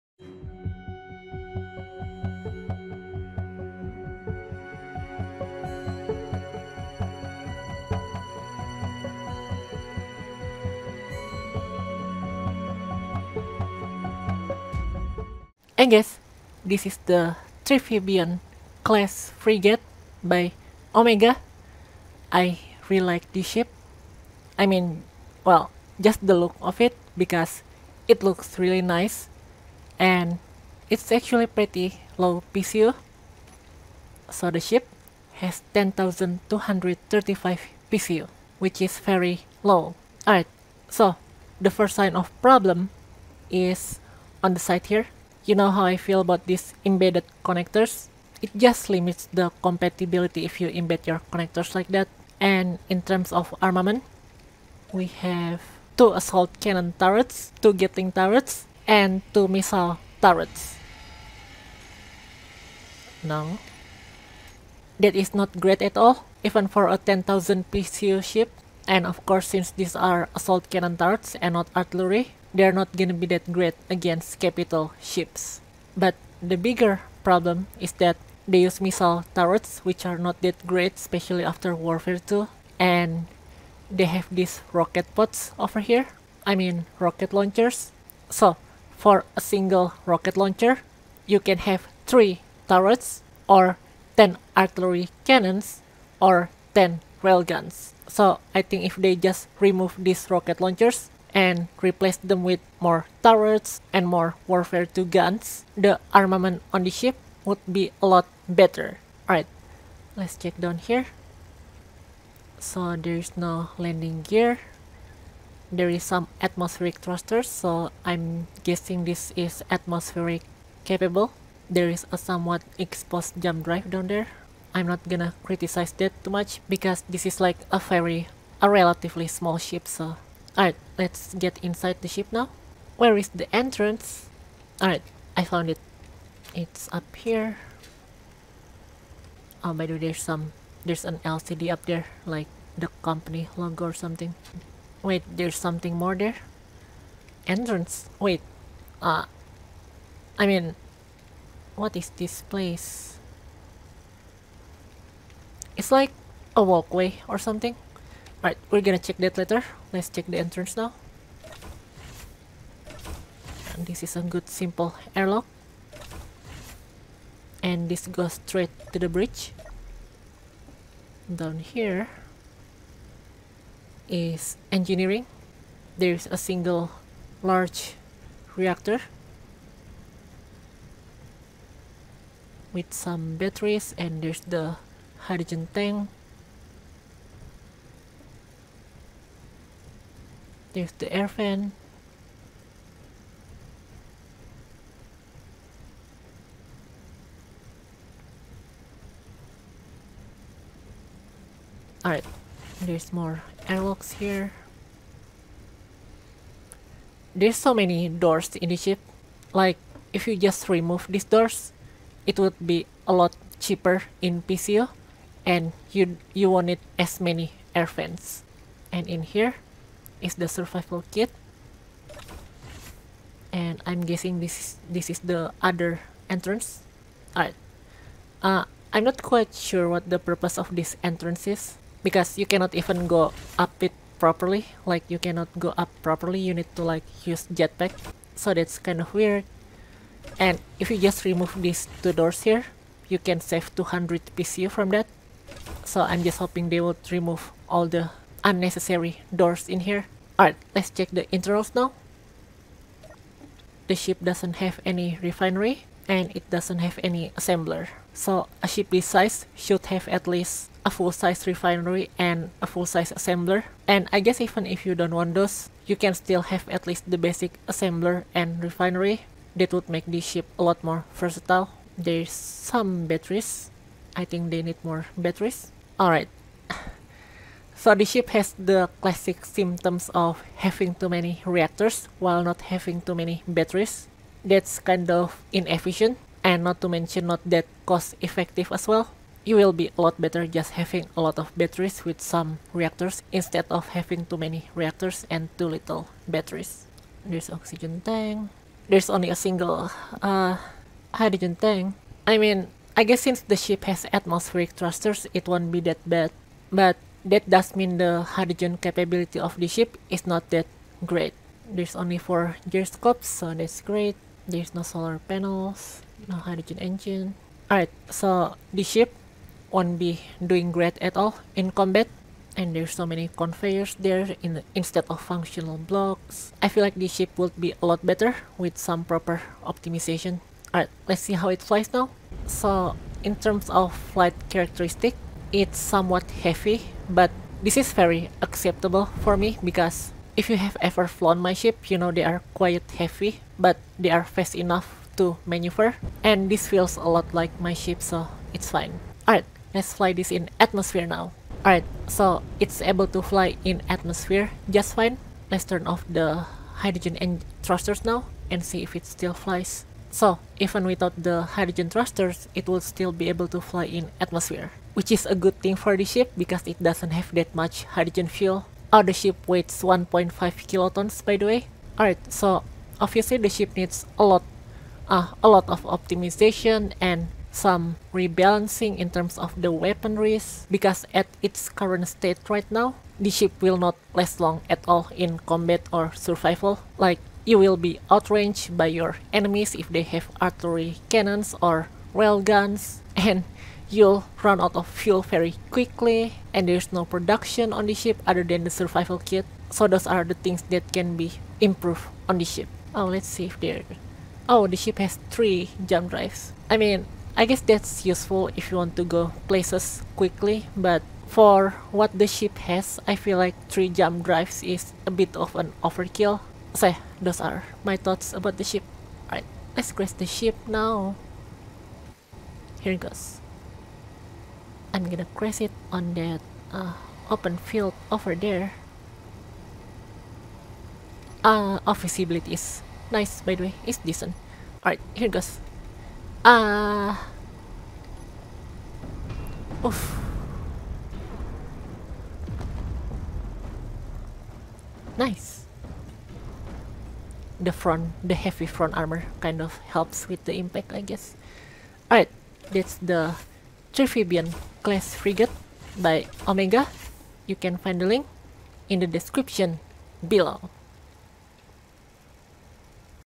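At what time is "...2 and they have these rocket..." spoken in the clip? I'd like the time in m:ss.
1:22.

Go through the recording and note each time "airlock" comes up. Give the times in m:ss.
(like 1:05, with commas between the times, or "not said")
2:45, 3:23.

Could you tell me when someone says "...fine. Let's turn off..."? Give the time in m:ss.
5:54.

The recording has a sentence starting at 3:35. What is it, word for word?
And you, you won't need as many air fans.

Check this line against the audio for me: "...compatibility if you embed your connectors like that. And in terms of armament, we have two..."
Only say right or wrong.
right.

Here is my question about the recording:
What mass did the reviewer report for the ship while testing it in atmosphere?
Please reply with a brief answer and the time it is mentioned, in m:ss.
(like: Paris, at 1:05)
1.5 kilotons, at 6:09.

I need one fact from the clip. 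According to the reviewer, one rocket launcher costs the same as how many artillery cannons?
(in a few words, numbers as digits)
10.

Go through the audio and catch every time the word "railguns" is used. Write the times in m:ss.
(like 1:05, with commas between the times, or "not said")
1:37, 6:32.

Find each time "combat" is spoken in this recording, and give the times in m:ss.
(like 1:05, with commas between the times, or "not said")
5:21, 6:25.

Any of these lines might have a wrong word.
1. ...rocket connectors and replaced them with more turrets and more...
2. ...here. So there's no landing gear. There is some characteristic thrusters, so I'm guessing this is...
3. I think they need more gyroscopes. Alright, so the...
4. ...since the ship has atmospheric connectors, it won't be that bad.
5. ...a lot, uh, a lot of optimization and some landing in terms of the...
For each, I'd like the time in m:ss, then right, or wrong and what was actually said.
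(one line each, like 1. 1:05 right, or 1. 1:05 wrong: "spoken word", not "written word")
1. 1:40 wrong: "launchers", not "connectors"
2. 1:50 wrong: "atmospheric", not "characteristic"
3. 4:34 wrong: "batteries", not "gyroscopes"
4. 5:03 wrong: "thrusters", not "connectors"
5. 6:14 wrong: "rebalancing", not "landing".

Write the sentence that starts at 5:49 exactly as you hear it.
Alright, let's fly this in atmosphere now.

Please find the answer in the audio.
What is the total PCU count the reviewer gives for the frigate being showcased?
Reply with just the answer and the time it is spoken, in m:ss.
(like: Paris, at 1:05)
10,235, at 0:35.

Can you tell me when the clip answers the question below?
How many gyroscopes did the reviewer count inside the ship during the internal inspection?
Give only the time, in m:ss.
5:12.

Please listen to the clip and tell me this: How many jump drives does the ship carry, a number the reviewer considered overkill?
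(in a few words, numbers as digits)
3.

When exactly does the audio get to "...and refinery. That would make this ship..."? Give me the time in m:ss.
4:28.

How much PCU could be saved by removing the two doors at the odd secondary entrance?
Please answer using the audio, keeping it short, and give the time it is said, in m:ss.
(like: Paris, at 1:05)
200, at 4:03.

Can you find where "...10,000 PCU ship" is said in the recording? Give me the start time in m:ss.
1:06.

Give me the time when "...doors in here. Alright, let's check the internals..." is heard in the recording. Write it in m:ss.
4:09.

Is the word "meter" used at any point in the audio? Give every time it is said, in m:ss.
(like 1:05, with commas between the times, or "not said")
not said.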